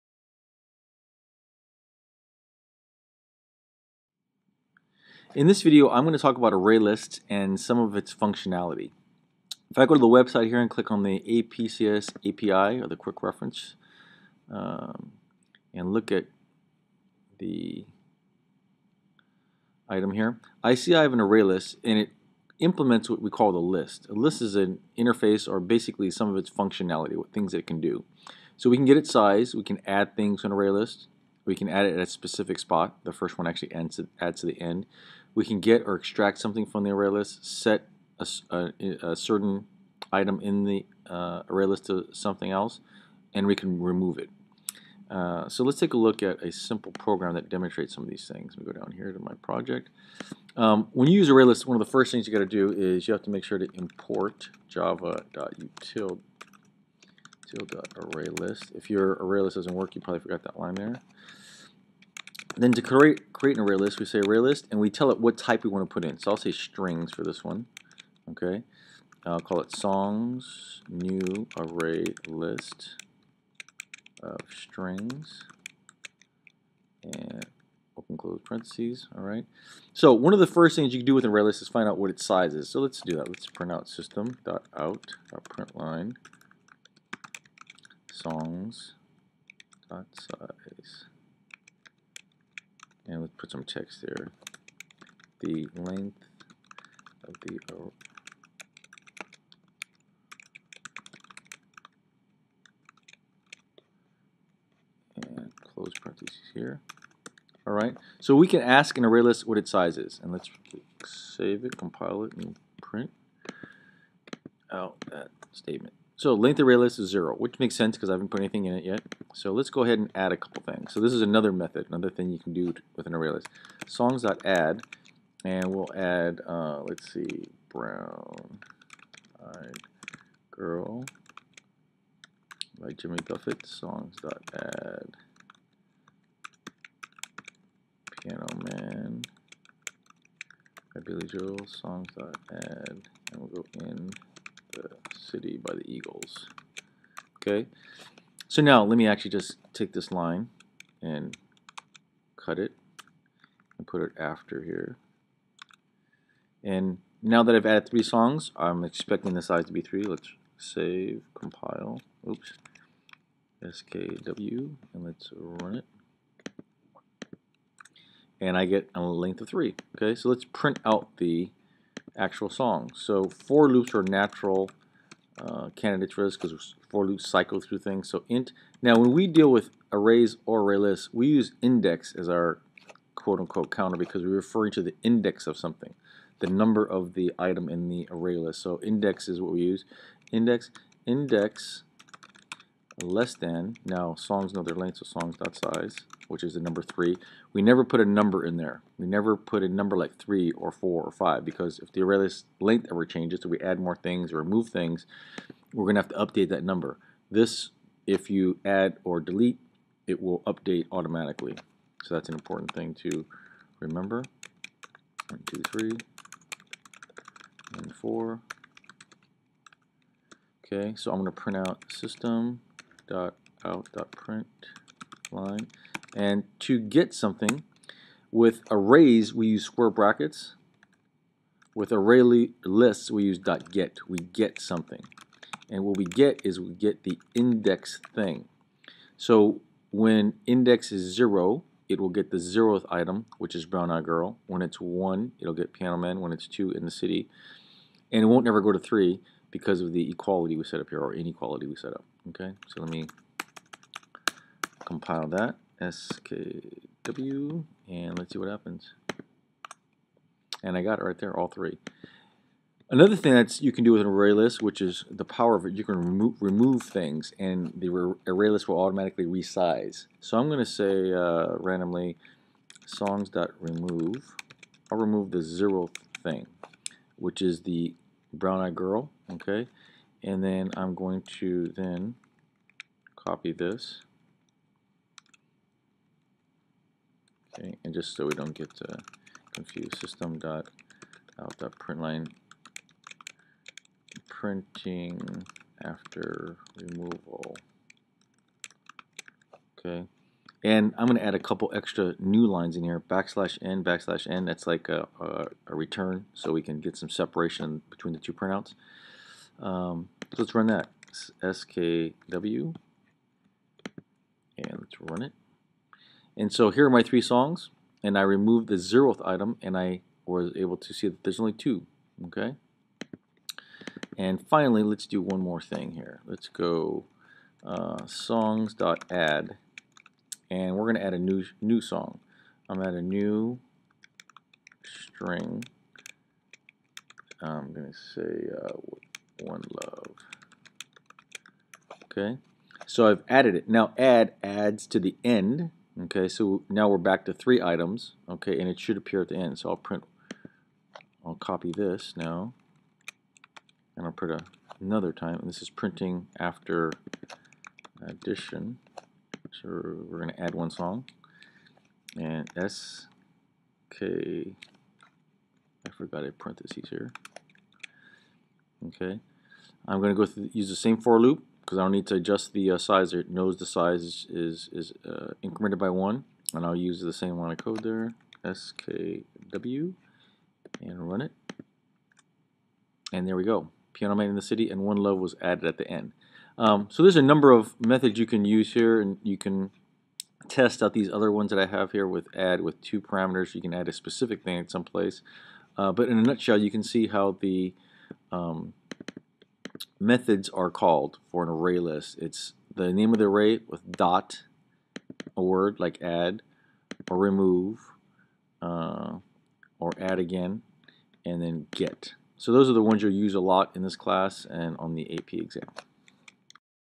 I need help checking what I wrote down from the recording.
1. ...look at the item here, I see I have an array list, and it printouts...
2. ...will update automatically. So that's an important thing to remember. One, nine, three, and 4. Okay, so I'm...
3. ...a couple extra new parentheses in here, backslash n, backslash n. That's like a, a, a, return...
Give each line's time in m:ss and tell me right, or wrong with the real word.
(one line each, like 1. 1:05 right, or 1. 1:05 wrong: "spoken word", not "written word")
1. 0:15 wrong: "implements", not "printouts"
2. 3:30 wrong: "two", not "nine"
3. 5:01 wrong: "lines", not "parentheses".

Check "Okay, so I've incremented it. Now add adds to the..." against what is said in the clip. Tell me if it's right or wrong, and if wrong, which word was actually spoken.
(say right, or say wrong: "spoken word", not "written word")
wrong: "added", not "incremented".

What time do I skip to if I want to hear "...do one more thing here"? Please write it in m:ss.
5:25.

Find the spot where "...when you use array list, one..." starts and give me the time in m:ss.
0:50.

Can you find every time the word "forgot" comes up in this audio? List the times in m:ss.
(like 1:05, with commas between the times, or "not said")
1:00, 6:05.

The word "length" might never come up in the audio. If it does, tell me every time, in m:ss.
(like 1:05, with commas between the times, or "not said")
1:35, 1:56, 2:49, 3:14, 3:22.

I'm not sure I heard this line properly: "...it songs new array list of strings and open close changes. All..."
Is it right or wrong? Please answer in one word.
wrong.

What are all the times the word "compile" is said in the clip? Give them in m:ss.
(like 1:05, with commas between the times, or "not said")
1:51, 2:41, 4:14.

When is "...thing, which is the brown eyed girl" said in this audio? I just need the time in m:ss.
4:36.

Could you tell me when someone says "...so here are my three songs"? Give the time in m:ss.
5:16.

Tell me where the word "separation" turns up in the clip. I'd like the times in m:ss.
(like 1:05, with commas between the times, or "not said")
5:07.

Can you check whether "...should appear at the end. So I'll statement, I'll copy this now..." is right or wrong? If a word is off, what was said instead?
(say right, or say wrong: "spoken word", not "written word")
wrong: "print", not "statement".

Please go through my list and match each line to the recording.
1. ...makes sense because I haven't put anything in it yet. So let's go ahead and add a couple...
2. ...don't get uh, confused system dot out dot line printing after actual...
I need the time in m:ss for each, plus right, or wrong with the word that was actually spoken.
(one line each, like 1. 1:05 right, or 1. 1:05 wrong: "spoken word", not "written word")
1. 1:57 right
2. 4:48 wrong: "removal", not "actual".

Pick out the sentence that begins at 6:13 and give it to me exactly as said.
It knows the size is, is, is uh, incremented by 1.